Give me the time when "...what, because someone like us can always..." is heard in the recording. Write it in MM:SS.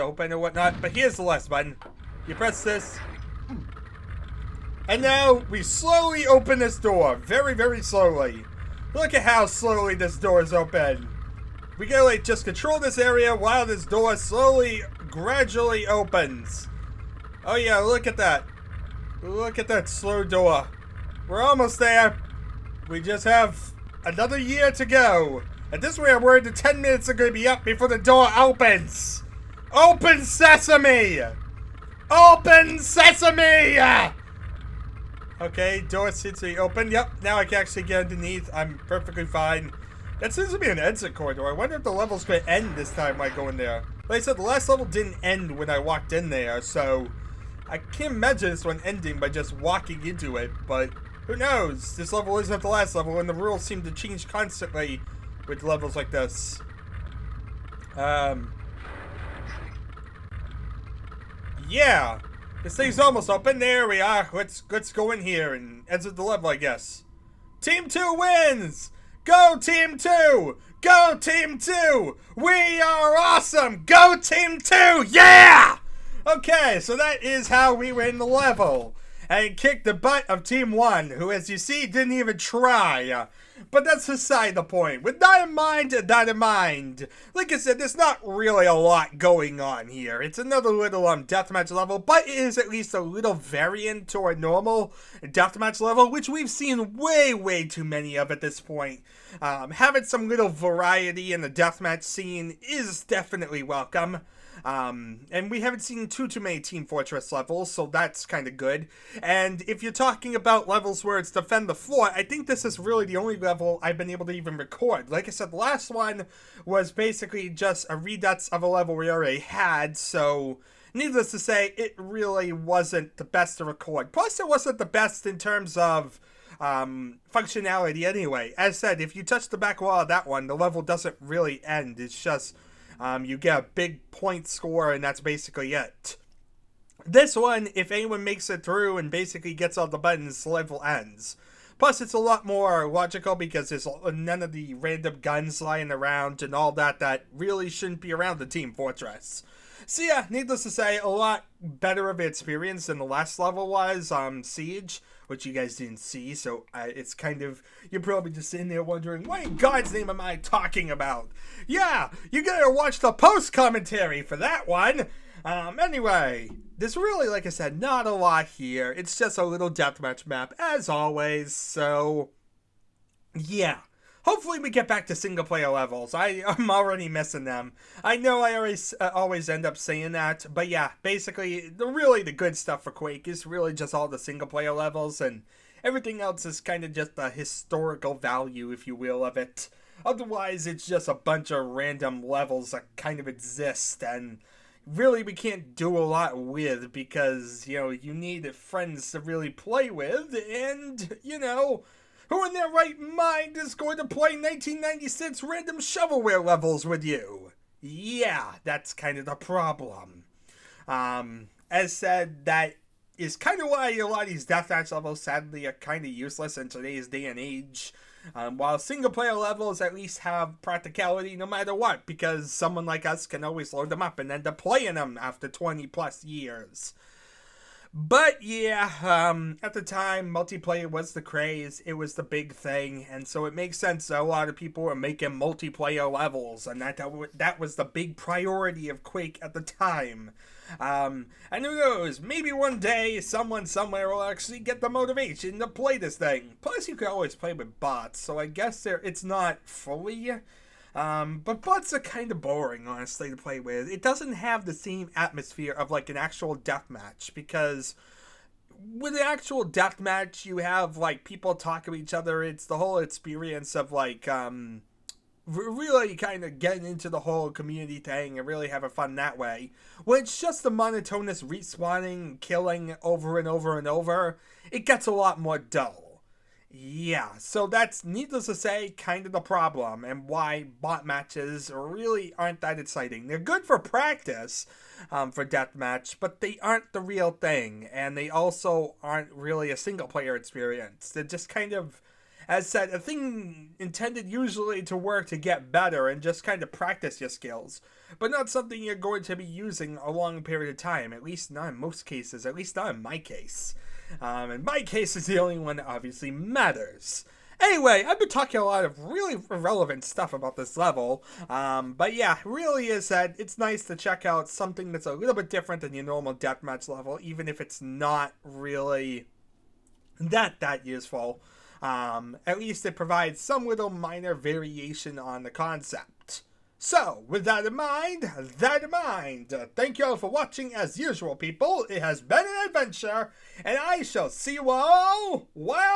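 03:41.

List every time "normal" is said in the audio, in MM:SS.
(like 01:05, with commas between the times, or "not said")
01:34, 05:16.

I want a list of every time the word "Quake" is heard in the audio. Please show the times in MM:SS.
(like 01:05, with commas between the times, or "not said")
03:02, 03:59.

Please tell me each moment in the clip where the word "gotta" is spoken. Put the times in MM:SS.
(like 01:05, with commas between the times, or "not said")
00:11, 02:42.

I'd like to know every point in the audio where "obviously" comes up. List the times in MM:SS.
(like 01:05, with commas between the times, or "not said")
05:05.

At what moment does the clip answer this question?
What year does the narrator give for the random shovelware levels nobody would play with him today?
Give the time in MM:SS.
03:24.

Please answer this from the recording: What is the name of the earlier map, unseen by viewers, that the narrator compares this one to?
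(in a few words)
Siege.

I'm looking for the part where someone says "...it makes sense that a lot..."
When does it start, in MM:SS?
03:53.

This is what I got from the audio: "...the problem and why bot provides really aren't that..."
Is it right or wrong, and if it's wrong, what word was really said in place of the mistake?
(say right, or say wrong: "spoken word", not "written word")
wrong: "matches", not "provides".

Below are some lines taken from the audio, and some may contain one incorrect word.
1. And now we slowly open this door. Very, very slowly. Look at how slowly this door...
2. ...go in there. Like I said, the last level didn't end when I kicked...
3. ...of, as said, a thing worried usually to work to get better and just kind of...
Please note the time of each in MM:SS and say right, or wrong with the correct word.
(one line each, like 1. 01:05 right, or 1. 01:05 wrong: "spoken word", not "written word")
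1. 00:04 right
2. 00:43 wrong: "walked", not "kicked"
3. 04:51 wrong: "intended", not "worried".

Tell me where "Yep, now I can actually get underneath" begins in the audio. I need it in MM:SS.
00:36.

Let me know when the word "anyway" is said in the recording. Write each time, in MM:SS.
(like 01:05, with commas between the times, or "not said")
02:08, 02:45, 05:07.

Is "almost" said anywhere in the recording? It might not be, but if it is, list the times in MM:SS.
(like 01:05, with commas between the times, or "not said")
00:21, 01:02.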